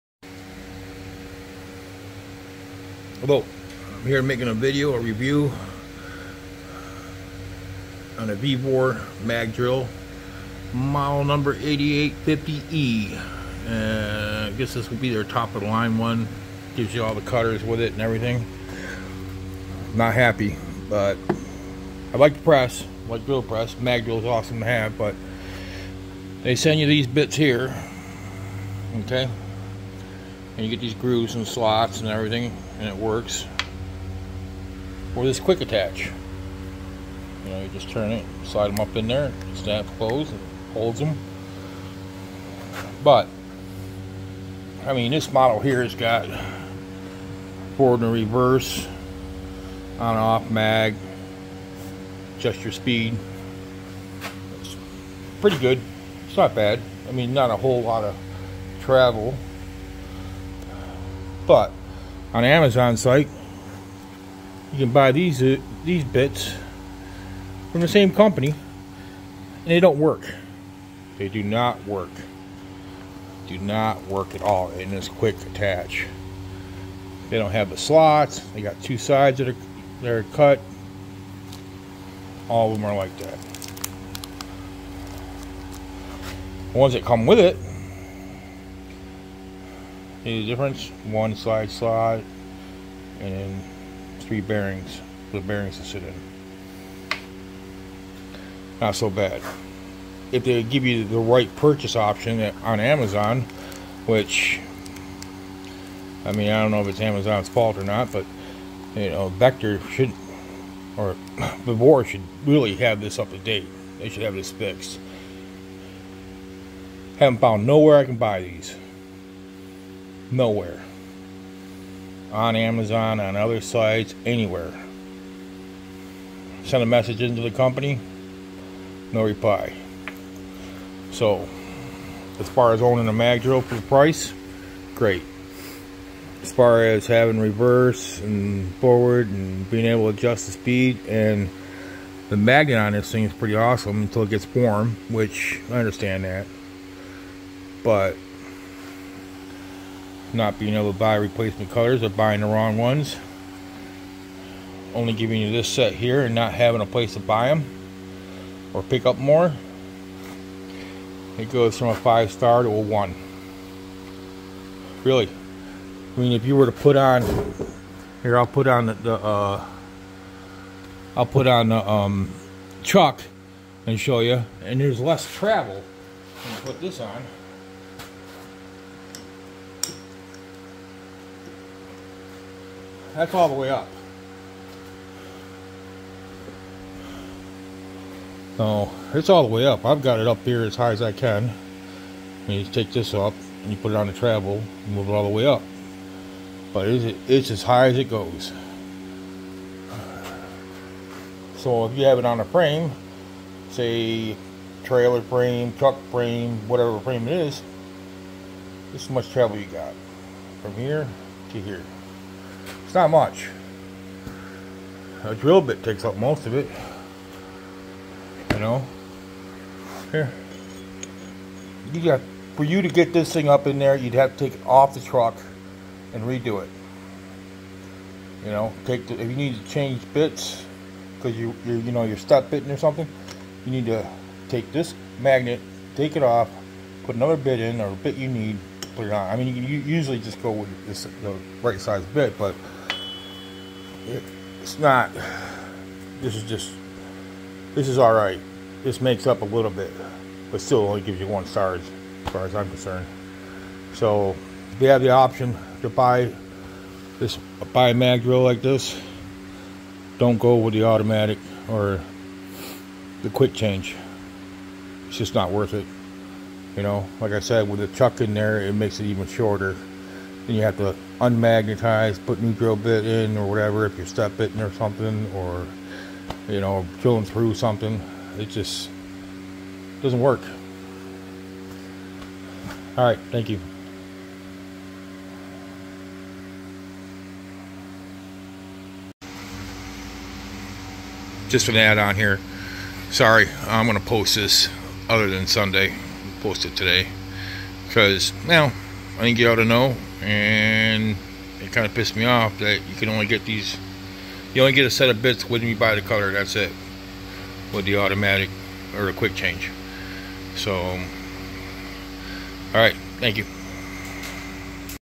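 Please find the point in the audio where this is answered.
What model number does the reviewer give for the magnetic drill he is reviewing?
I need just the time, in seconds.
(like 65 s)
11 s.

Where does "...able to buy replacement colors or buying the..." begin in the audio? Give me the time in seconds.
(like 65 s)
150 s.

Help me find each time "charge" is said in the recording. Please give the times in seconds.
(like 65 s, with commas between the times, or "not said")
251 s.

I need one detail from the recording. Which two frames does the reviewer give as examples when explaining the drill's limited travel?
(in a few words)
Trailer frame, truck frame.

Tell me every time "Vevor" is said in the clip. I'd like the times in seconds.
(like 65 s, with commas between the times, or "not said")
8 s.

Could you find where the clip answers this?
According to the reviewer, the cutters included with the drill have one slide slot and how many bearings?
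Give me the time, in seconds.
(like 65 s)
94 s.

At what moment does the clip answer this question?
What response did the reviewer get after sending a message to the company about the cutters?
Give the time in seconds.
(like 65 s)
129 s.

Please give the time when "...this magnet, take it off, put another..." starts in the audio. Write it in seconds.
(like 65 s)
234 s.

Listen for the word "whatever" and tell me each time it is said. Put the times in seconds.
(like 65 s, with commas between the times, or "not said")
206 s, 273 s.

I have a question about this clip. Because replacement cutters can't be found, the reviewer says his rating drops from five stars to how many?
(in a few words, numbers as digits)
1.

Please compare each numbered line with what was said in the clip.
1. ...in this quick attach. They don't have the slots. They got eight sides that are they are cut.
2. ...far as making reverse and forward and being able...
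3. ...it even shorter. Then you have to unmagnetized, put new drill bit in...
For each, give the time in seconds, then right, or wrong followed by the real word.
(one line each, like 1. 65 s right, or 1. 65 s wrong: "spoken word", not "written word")
1. 74 s wrong: "two", not "eight"
2. 136 s wrong: "having", not "making"
3. 268 s right.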